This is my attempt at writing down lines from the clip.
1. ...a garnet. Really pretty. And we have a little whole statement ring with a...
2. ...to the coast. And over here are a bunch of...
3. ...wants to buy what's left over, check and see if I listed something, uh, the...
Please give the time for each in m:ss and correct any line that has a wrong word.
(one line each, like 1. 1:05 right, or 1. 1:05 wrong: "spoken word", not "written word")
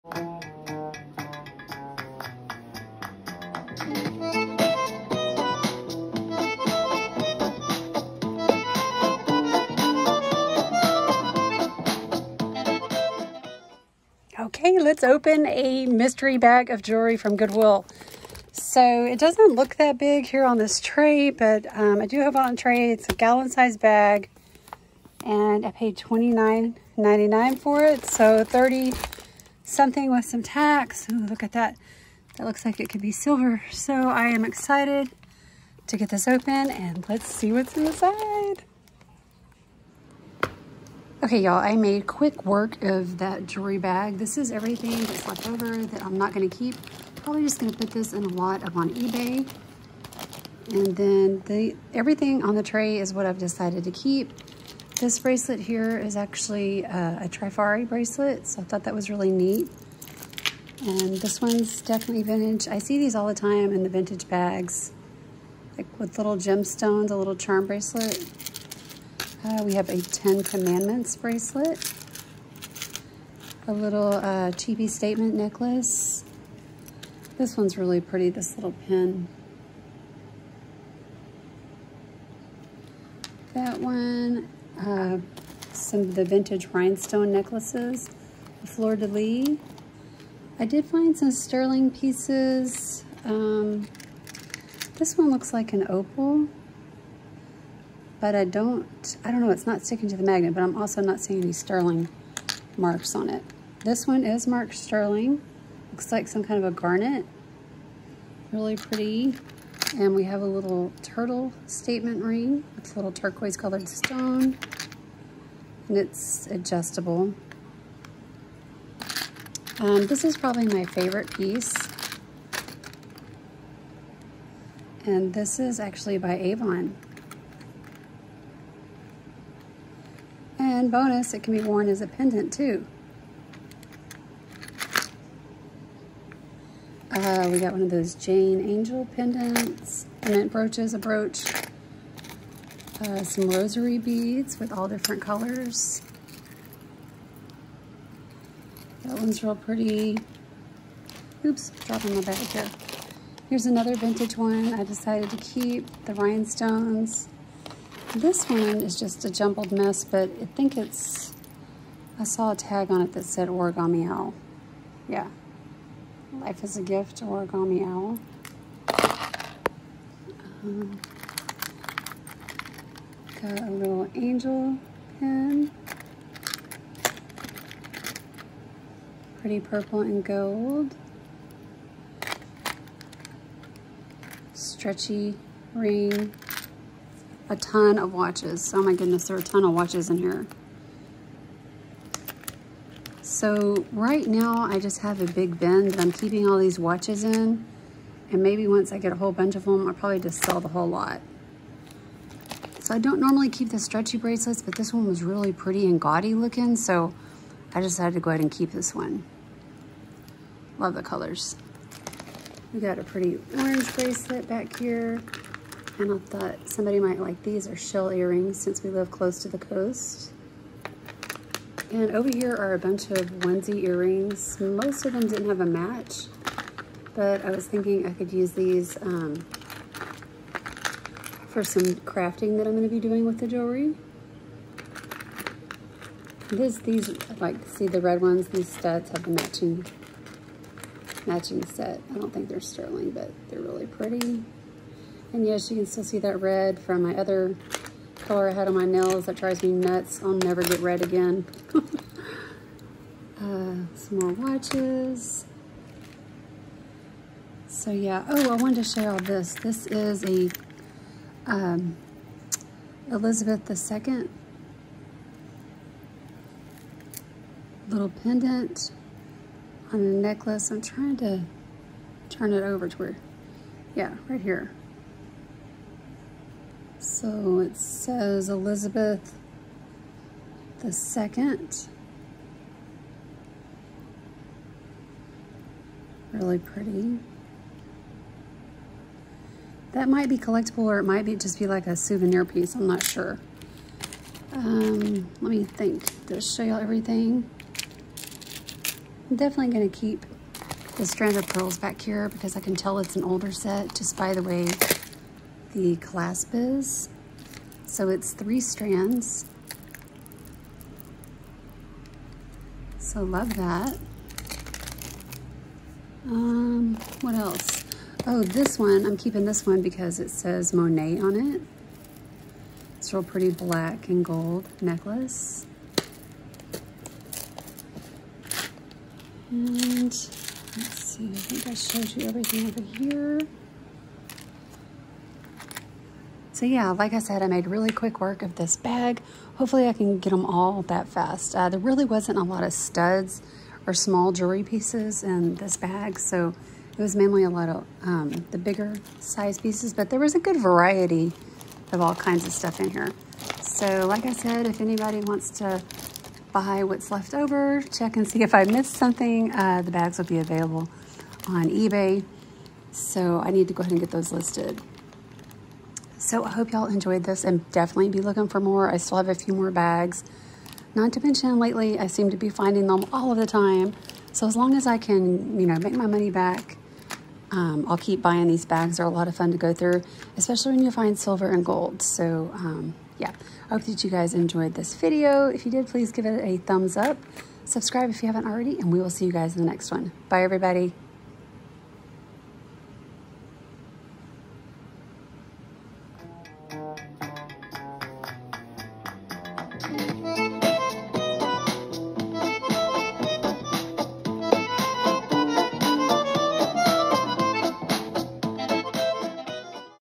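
1. 1:46 wrong: "turtle", not "whole"
2. 3:39 right
3. 5:55 wrong: "missed", not "listed".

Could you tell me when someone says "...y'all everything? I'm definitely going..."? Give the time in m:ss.
4:56.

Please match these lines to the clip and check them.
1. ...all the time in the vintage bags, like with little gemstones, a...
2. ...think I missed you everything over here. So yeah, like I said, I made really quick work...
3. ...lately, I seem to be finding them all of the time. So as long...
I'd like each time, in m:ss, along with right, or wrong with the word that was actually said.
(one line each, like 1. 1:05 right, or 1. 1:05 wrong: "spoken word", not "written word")
1. 1:03 right
2. 5:31 wrong: "showed", not "missed"
3. 6:11 right.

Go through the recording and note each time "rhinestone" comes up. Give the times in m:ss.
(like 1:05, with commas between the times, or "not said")
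1:26, 2:36.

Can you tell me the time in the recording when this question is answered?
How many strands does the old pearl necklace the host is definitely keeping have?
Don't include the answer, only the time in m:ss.
5:08.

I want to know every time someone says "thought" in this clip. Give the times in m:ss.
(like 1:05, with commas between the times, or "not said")
0:58, 3:36.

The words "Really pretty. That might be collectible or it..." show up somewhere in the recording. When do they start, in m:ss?
4:46.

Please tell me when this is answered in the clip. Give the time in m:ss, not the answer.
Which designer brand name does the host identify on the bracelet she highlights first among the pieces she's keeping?
0:57.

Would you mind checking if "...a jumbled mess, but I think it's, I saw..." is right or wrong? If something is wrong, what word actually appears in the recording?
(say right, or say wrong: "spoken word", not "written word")
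right.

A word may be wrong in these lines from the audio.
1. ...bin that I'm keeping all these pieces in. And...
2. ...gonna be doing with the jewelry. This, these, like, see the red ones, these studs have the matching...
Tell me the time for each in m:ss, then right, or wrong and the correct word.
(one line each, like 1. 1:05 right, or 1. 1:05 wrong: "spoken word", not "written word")
1. 3:15 wrong: "watches", not "pieces"
2. 3:52 right.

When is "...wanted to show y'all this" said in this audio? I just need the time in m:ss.
4:18.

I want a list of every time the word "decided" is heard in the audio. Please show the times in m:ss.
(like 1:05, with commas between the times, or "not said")
0:53, 2:34, 3:27.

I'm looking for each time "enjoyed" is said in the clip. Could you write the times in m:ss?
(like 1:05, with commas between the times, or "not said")
6:06, 6:24.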